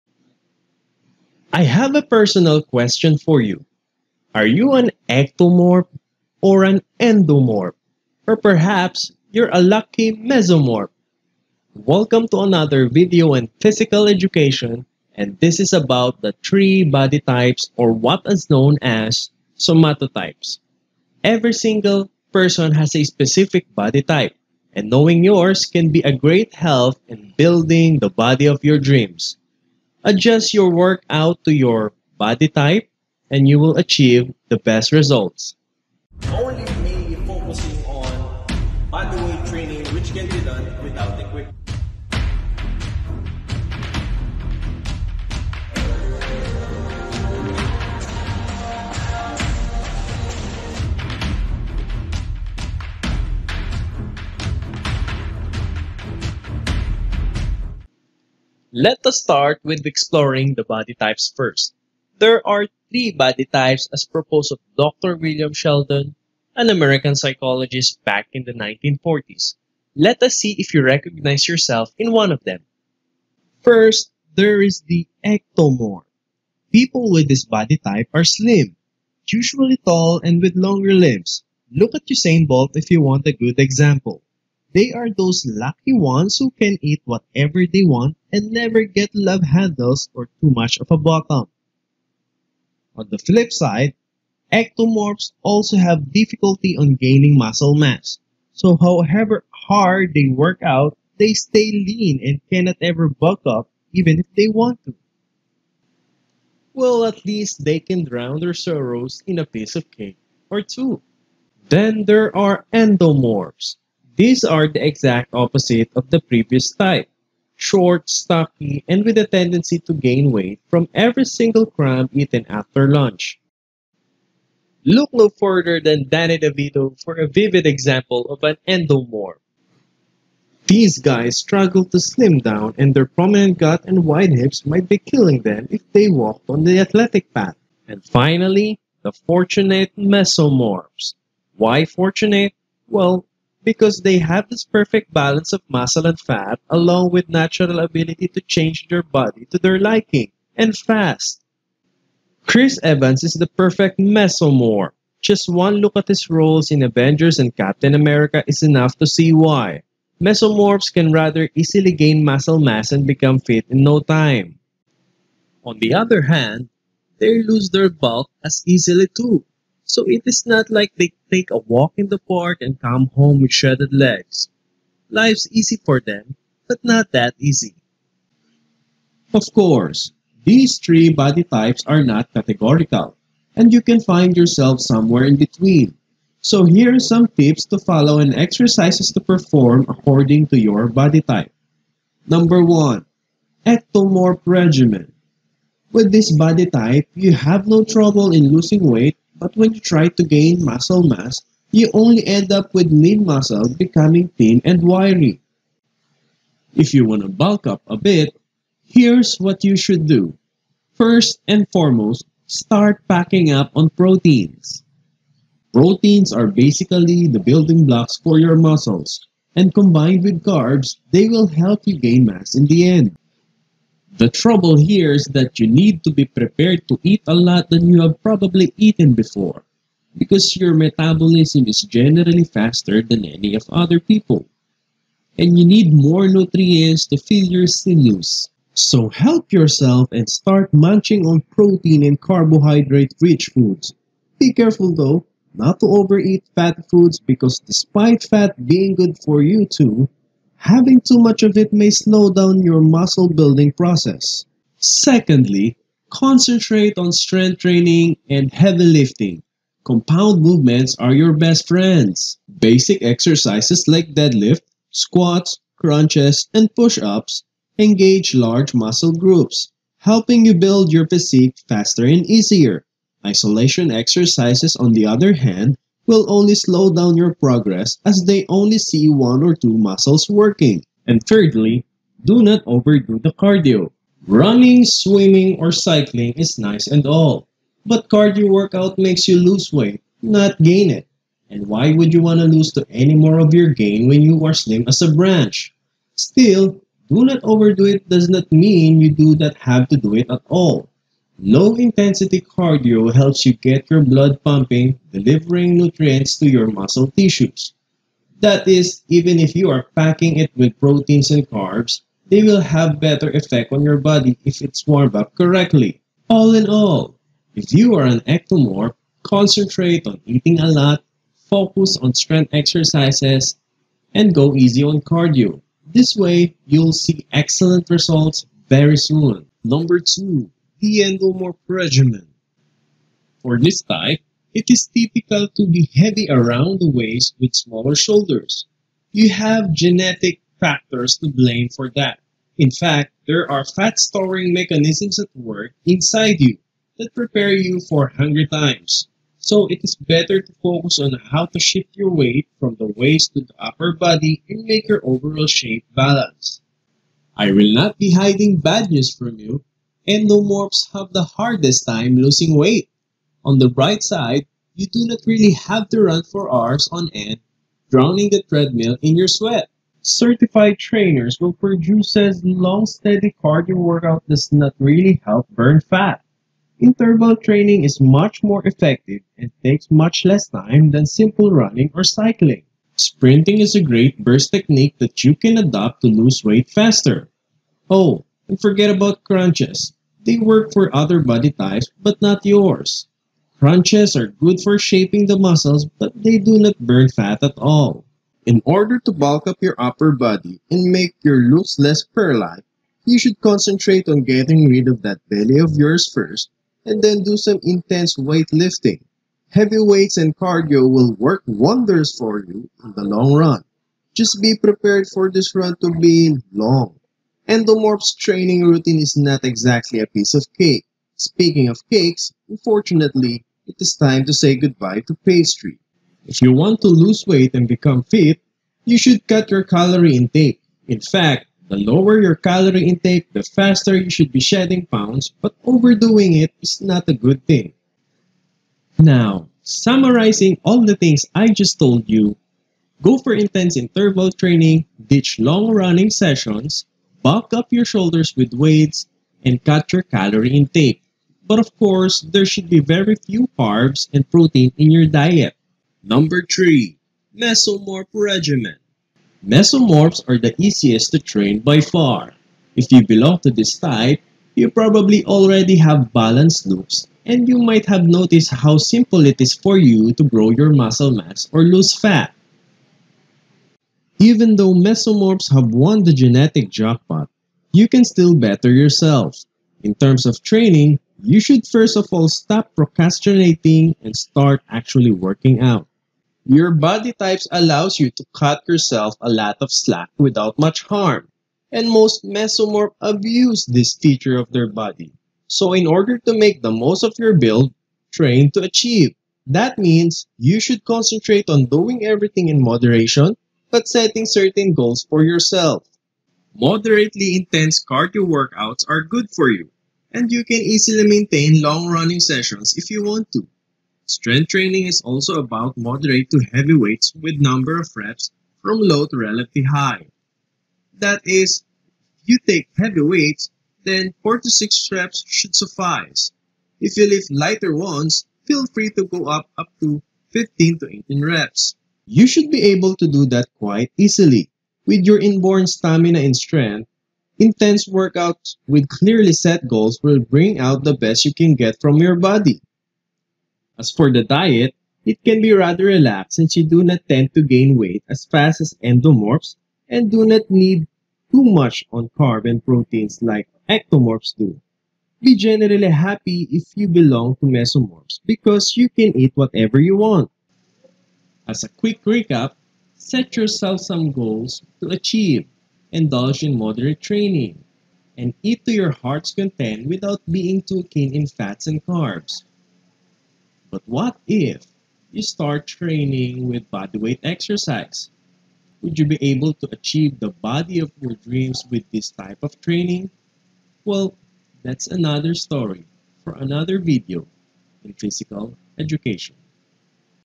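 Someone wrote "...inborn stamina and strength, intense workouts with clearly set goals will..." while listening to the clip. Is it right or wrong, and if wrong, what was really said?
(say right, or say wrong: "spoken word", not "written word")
right.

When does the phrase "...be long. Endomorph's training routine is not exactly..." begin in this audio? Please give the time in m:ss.
6:55.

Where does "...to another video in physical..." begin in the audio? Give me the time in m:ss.
0:12.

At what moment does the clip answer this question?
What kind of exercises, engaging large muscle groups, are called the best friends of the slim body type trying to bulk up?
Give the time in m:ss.
4:19.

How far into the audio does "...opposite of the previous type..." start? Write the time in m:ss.
1:55.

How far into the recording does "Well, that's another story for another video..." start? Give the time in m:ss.
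9:43.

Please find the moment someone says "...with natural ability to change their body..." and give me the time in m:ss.
2:27.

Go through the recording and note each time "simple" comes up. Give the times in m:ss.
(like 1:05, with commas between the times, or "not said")
6:21, 7:48.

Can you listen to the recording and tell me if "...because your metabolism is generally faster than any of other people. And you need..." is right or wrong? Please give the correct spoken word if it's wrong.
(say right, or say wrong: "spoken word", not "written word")
right.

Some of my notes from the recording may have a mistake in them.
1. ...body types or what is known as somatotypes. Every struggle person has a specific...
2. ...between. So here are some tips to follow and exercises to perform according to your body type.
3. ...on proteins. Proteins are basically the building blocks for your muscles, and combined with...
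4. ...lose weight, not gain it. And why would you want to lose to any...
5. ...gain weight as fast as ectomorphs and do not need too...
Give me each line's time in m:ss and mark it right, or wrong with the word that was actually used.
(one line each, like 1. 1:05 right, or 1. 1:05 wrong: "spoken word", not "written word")
1. 0:16 wrong: "single", not "struggle"
2. 3:05 right
3. 3:33 right
4. 4:49 right
5. 9:07 wrong: "endomorphs", not "ectomorphs".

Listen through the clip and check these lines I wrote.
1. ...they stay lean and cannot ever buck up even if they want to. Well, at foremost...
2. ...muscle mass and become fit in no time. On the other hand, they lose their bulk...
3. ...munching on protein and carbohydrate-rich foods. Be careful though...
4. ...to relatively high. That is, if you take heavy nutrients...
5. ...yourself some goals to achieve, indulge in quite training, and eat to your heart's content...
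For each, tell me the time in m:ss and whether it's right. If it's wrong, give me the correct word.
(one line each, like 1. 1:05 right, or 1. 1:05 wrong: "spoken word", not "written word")
1. 1:41 wrong: "least", not "foremost"
2. 2:42 right
3. 4:00 right
4. 8:39 wrong: "weights", not "nutrients"
5. 9:23 wrong: "moderate", not "quite".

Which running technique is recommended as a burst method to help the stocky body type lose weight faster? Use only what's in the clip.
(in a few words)
Sprinting.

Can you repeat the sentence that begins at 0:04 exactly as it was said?
Are you an ectomorph or an endomorph?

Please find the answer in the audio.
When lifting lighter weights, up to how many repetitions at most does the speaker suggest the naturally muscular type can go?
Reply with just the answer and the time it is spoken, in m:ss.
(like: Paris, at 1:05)
18, at 8:51.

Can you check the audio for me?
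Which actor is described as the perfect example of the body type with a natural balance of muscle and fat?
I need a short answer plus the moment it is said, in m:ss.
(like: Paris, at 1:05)
Chris Evans, at 2:32.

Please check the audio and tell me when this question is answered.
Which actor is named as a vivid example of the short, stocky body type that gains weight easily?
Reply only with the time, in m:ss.
2:06.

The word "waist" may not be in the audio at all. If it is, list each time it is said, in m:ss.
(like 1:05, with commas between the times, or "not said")
5:36, 5:52.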